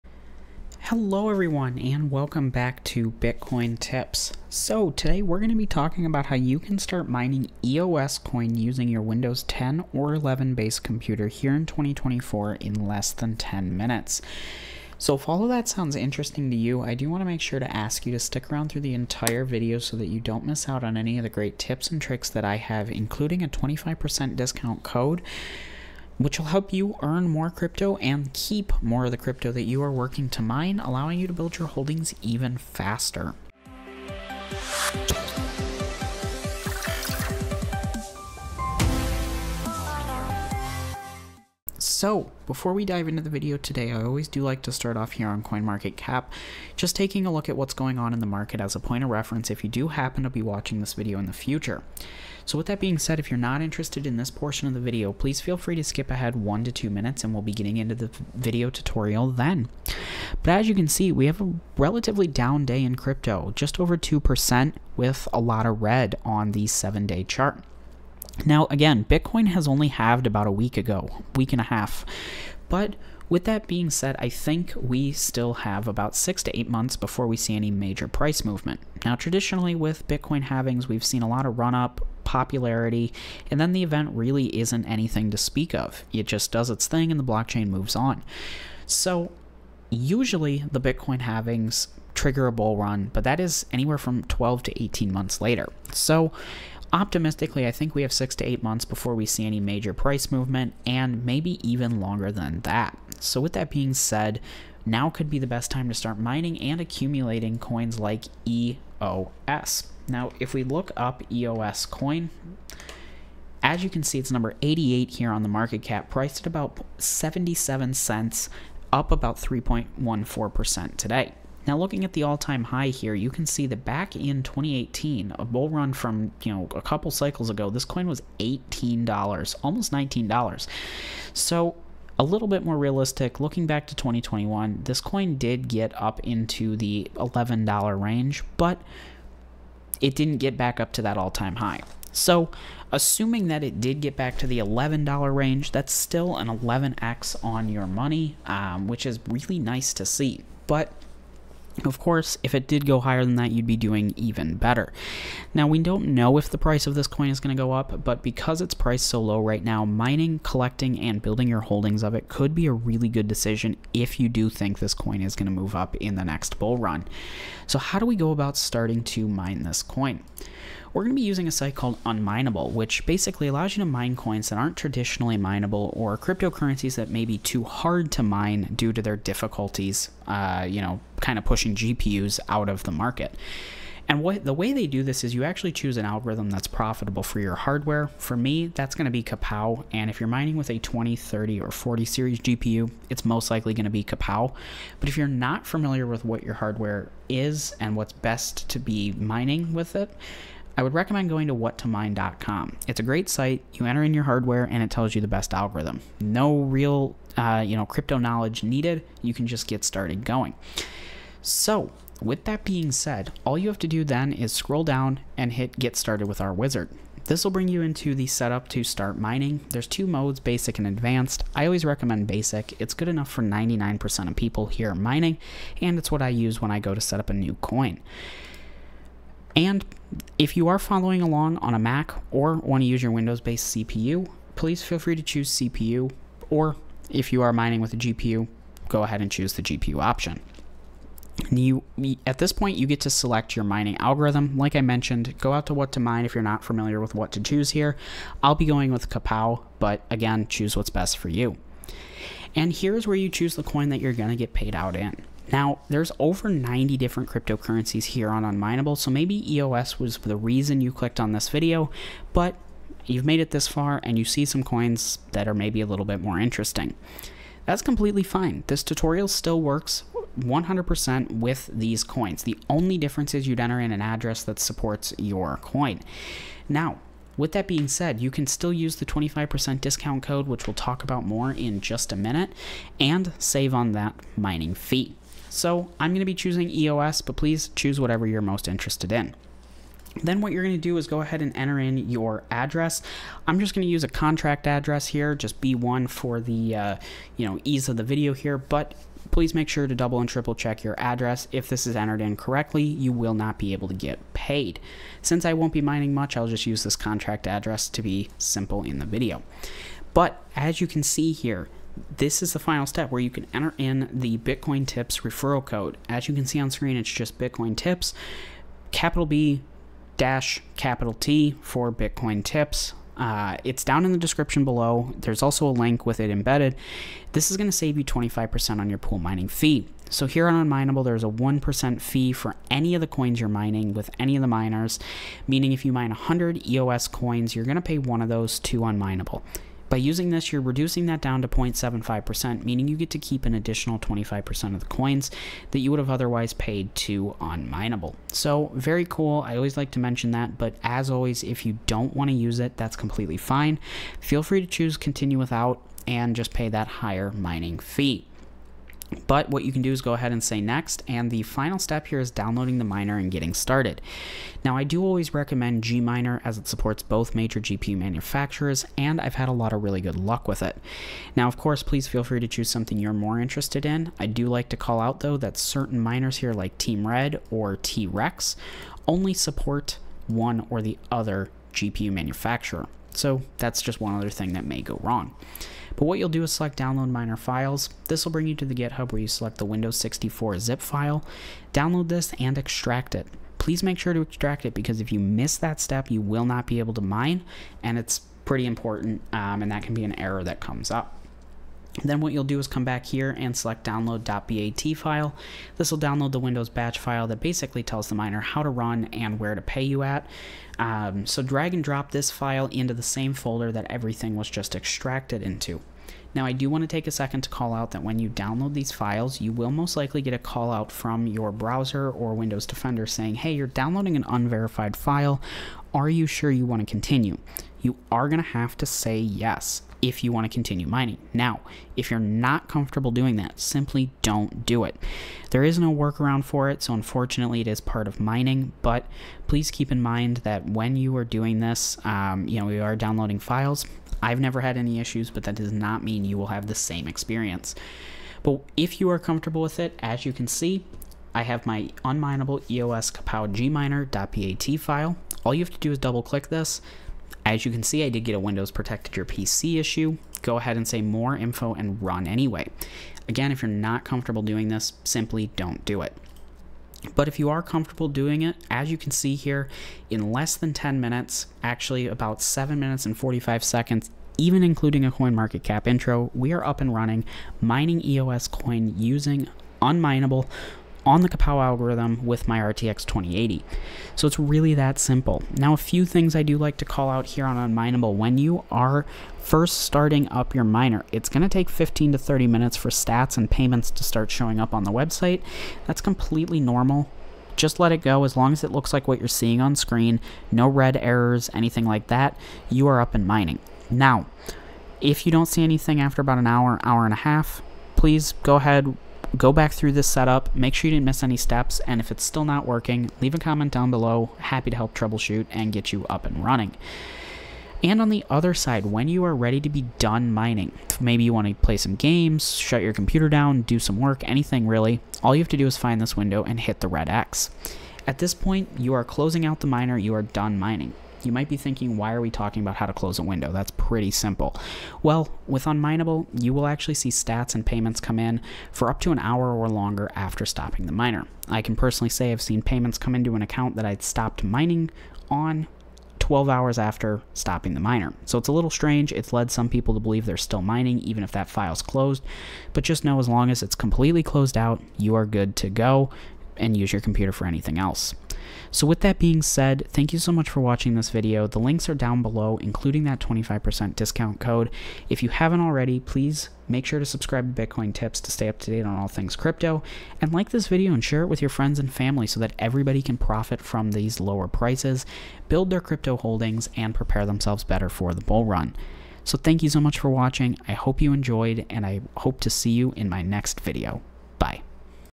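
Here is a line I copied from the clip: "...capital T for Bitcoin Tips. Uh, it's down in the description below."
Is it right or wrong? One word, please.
right.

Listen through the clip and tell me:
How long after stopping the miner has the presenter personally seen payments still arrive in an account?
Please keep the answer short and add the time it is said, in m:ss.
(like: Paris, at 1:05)
12 hours, at 9:06.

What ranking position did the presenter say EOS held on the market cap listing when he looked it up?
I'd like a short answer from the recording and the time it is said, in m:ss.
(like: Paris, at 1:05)
88, at 1:54.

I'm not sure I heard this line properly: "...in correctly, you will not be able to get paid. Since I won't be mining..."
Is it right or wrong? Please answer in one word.
right.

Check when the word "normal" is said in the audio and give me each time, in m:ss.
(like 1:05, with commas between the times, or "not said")
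8:16.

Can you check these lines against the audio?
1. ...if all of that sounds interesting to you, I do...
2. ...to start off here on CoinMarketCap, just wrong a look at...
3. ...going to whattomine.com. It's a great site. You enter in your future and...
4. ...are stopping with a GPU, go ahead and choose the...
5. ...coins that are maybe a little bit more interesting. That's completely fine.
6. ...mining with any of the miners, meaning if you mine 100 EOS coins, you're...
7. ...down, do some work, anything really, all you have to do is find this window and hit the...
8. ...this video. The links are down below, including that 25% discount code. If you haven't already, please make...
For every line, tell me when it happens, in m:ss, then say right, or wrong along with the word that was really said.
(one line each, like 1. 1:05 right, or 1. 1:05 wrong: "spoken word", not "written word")
1. 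0:15 right
2. 0:44 wrong: "taking", not "wrong"
3. 3:21 wrong: "hardware", not "future"
4. 3:57 wrong: "mining", not "stopping"
5. 4:24 right
6. 5:33 right
7. 8:43 right
8. 9:20 right.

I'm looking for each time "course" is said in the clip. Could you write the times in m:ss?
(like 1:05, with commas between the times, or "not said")
2:31, 6:11.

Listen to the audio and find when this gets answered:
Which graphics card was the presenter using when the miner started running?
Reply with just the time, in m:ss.
8:02.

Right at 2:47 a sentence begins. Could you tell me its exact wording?
So how do we go about starting to mine this coin?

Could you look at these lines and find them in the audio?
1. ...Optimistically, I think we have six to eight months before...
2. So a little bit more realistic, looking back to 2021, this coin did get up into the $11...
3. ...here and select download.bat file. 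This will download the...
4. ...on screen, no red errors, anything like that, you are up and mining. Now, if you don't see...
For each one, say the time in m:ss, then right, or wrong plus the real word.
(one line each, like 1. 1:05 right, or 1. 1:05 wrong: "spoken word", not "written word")
1. 1:36 right
2. 2:11 right
3. 6:43 right
4. 8:19 right.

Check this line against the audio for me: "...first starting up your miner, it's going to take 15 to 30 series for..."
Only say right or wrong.
wrong.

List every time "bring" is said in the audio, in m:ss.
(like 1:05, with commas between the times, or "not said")
3:37, 6:28.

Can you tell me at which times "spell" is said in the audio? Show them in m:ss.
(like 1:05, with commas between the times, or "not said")
not said.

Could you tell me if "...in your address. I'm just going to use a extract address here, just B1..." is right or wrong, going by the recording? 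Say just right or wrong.
wrong.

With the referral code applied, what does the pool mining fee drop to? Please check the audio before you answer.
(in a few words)
0.75%.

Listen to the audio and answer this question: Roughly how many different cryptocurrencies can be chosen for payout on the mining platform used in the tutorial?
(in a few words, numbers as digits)
over 90.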